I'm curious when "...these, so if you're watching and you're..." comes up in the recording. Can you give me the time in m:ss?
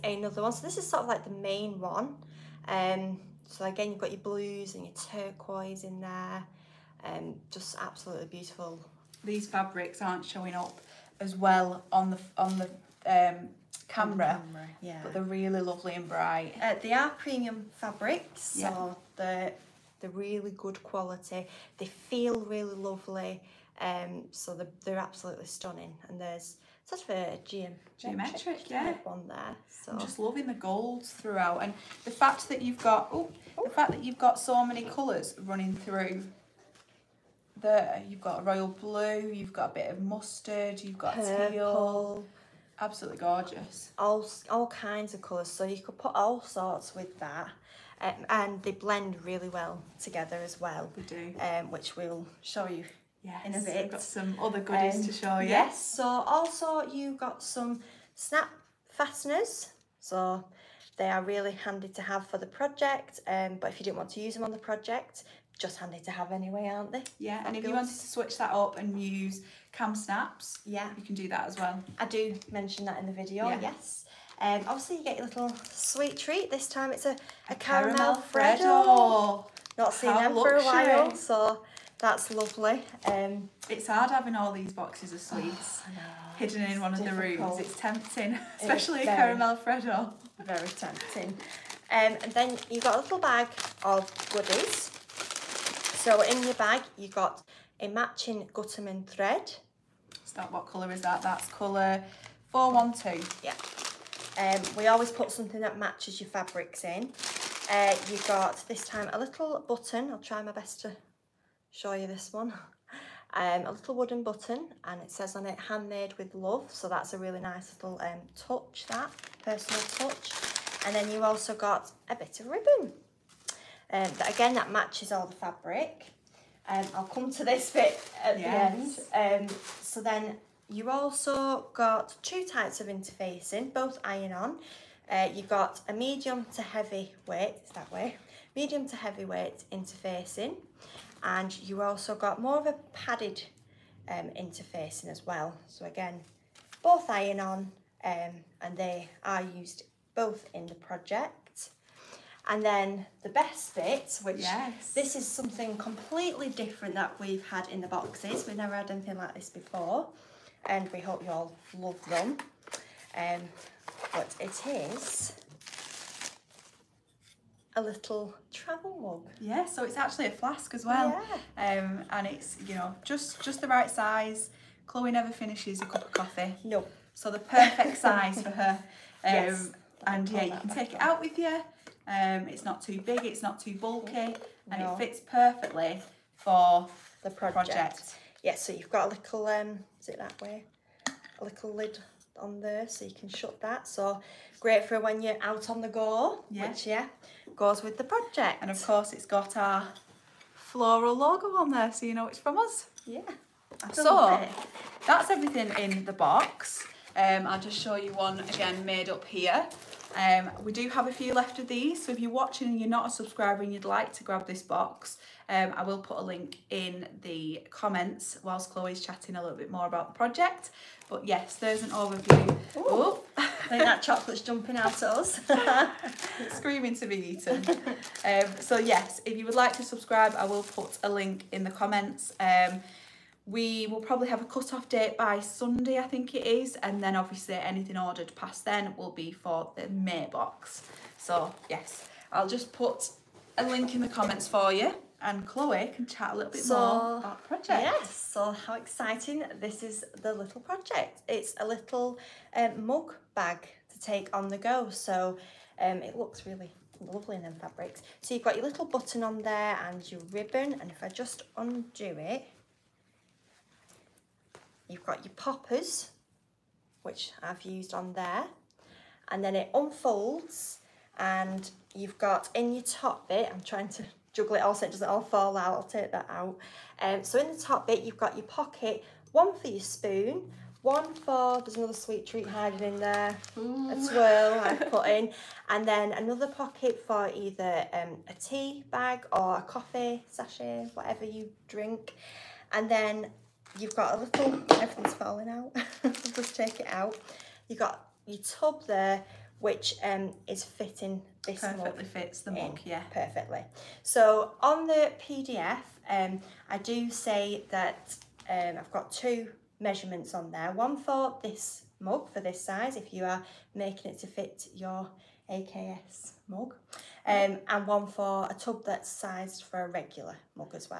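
3:31.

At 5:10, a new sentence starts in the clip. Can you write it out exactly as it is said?
One for this mug, for this size, if you are making it to fit your AKS mug.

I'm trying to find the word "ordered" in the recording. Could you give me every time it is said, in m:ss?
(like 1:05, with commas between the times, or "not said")
3:57.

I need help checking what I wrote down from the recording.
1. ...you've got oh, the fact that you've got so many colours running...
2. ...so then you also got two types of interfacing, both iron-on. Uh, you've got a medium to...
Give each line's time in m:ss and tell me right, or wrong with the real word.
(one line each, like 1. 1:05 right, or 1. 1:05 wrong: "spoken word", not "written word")
1. 0:32 right
2. 2:09 right.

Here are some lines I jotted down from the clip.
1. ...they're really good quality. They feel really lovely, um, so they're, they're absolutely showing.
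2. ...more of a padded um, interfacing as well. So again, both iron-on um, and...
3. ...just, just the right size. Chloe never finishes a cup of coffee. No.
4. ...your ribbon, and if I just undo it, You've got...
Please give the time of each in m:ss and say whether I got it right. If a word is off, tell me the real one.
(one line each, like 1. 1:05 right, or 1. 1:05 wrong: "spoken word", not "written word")
1. 0:20 wrong: "stunning", not "showing"
2. 2:22 right
3. 2:53 right
4. 4:20 right.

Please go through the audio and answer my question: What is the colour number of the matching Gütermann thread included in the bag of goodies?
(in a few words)
412.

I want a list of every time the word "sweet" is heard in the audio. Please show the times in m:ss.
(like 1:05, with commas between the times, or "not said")
1:15, 1:25, 4:41.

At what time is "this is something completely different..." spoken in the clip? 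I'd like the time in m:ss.
2:34.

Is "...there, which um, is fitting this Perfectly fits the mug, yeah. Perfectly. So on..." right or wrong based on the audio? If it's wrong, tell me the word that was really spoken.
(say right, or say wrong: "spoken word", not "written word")
right.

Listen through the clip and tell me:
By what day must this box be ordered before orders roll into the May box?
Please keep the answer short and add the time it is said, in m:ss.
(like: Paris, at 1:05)
Sunday, at 3:55.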